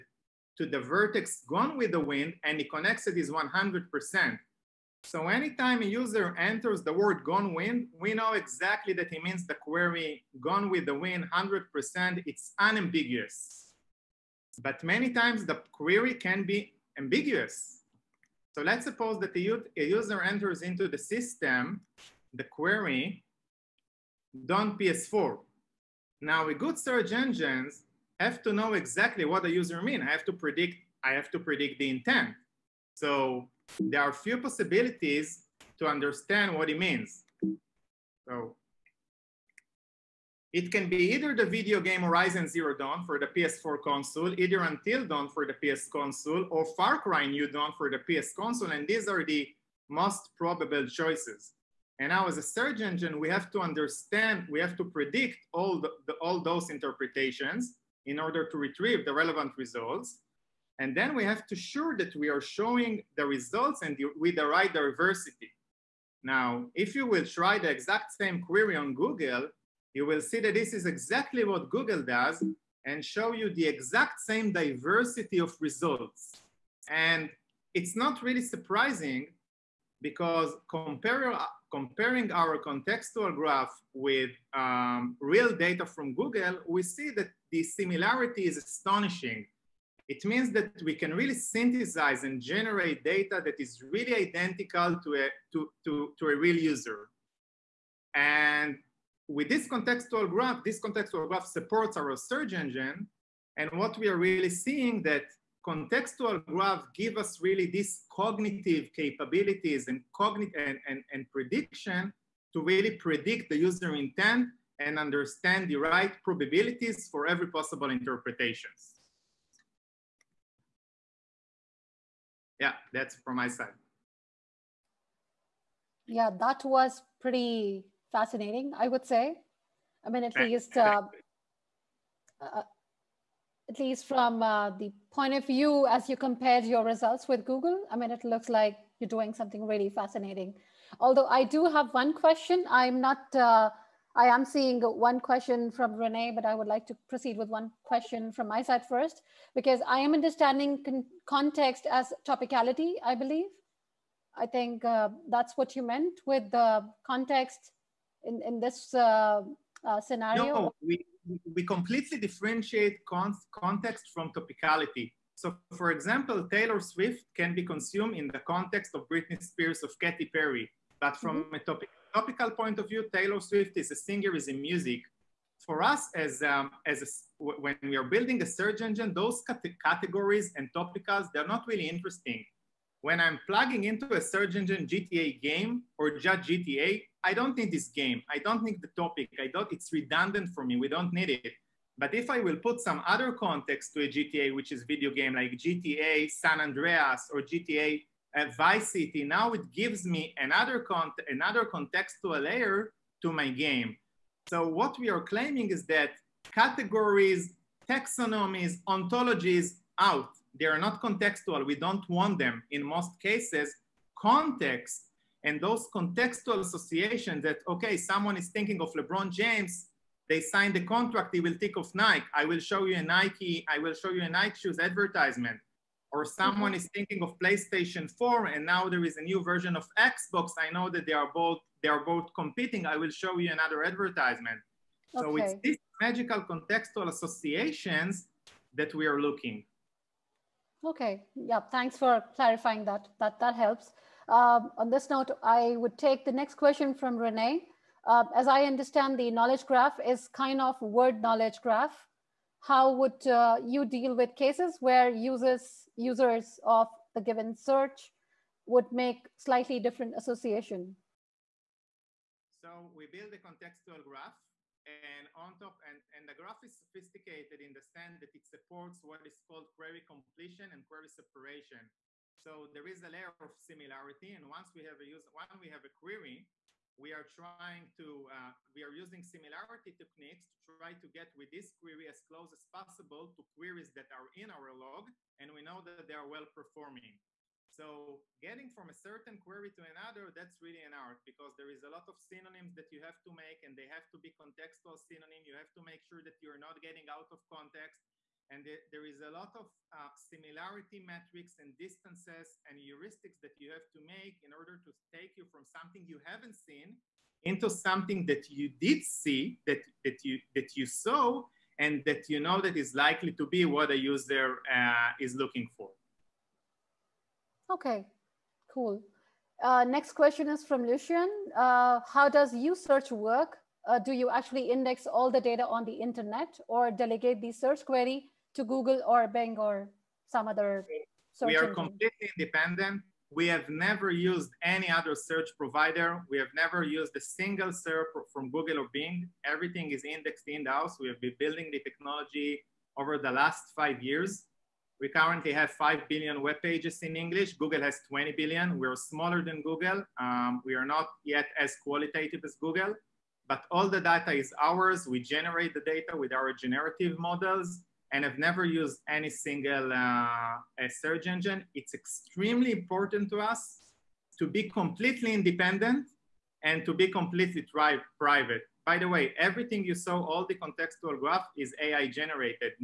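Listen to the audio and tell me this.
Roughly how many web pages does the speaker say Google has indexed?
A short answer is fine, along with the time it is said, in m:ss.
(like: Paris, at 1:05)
20 billion, at 5:48.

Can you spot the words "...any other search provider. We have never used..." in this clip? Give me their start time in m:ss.
5:34.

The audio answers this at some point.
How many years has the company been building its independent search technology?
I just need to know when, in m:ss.
5:43.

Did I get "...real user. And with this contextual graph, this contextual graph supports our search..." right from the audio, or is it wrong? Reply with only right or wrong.
right.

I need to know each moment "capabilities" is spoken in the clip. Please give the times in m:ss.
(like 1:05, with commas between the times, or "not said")
1:48.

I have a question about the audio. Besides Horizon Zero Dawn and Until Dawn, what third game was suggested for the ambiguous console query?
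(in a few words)
Far Cry New Dawn.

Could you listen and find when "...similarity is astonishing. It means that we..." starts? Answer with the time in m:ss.
1:27.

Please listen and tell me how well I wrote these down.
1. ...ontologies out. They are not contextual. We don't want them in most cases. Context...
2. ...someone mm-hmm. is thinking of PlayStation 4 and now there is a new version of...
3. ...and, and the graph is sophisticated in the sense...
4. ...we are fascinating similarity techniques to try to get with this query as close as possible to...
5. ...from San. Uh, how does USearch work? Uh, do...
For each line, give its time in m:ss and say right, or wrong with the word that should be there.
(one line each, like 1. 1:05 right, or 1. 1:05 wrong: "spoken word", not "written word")
1. 3:28 right
2. 3:46 right
3. 4:25 right
4. 4:38 wrong: "using", not "fascinating"
5. 5:20 wrong: "Lucian", not "San".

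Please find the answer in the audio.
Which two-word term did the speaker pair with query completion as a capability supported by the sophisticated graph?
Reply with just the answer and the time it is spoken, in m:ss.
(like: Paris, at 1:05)
query separation, at 4:30.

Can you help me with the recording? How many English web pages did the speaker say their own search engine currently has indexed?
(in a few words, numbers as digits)
5 billion.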